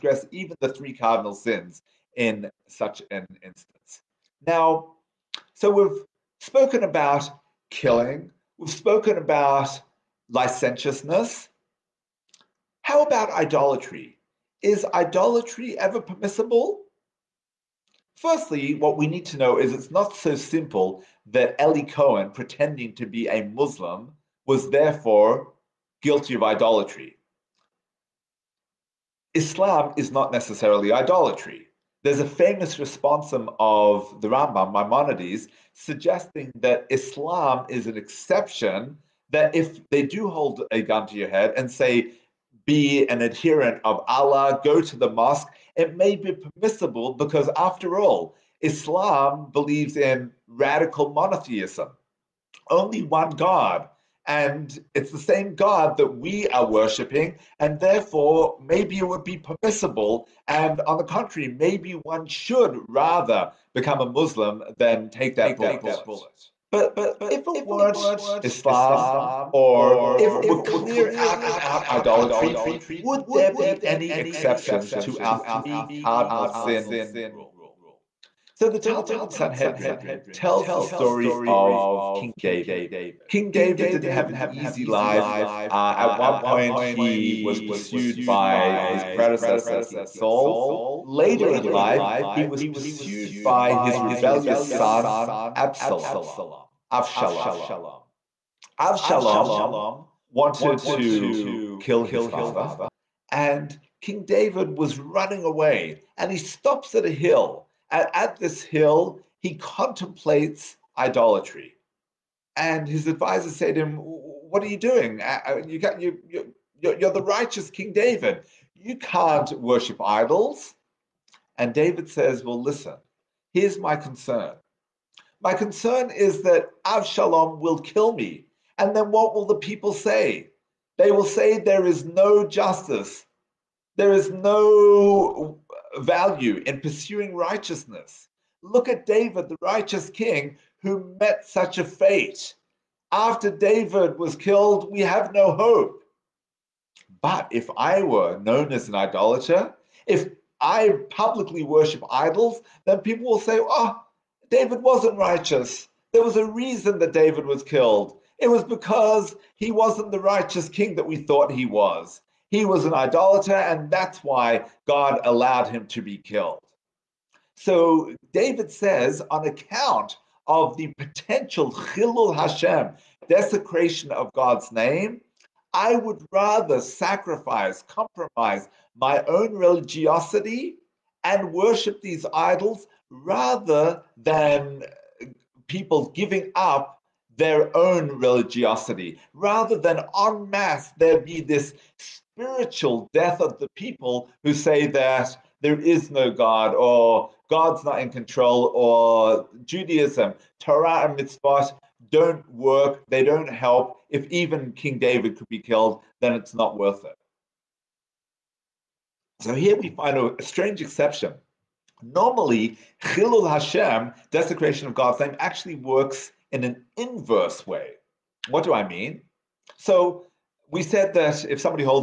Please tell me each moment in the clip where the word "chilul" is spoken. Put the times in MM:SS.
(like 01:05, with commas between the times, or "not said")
02:51, 03:33.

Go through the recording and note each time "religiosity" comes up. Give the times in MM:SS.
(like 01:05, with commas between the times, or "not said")
02:59, 03:08.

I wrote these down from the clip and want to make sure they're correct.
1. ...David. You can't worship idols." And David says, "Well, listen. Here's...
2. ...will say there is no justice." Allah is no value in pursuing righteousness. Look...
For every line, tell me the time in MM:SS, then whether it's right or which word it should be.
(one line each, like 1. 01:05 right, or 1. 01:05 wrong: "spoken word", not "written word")
1. 01:57 right
2. 02:11 wrong: "There", not "Allah".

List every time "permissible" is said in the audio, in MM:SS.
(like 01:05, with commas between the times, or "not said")
00:16, 00:46, 00:59.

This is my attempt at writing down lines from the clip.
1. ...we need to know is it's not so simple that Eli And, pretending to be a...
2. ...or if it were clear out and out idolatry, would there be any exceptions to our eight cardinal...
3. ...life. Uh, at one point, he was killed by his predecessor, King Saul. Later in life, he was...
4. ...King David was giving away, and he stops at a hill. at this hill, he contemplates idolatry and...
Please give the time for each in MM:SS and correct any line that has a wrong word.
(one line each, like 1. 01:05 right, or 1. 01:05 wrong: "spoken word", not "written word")
1. 00:18 wrong: "Cohen", not "And"
2. 01:09 wrong: "three", not "eight"
3. 01:24 wrong: "pursued", not "killed"
4. 01:44 wrong: "running", not "giving".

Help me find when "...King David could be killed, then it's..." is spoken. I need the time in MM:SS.
03:24.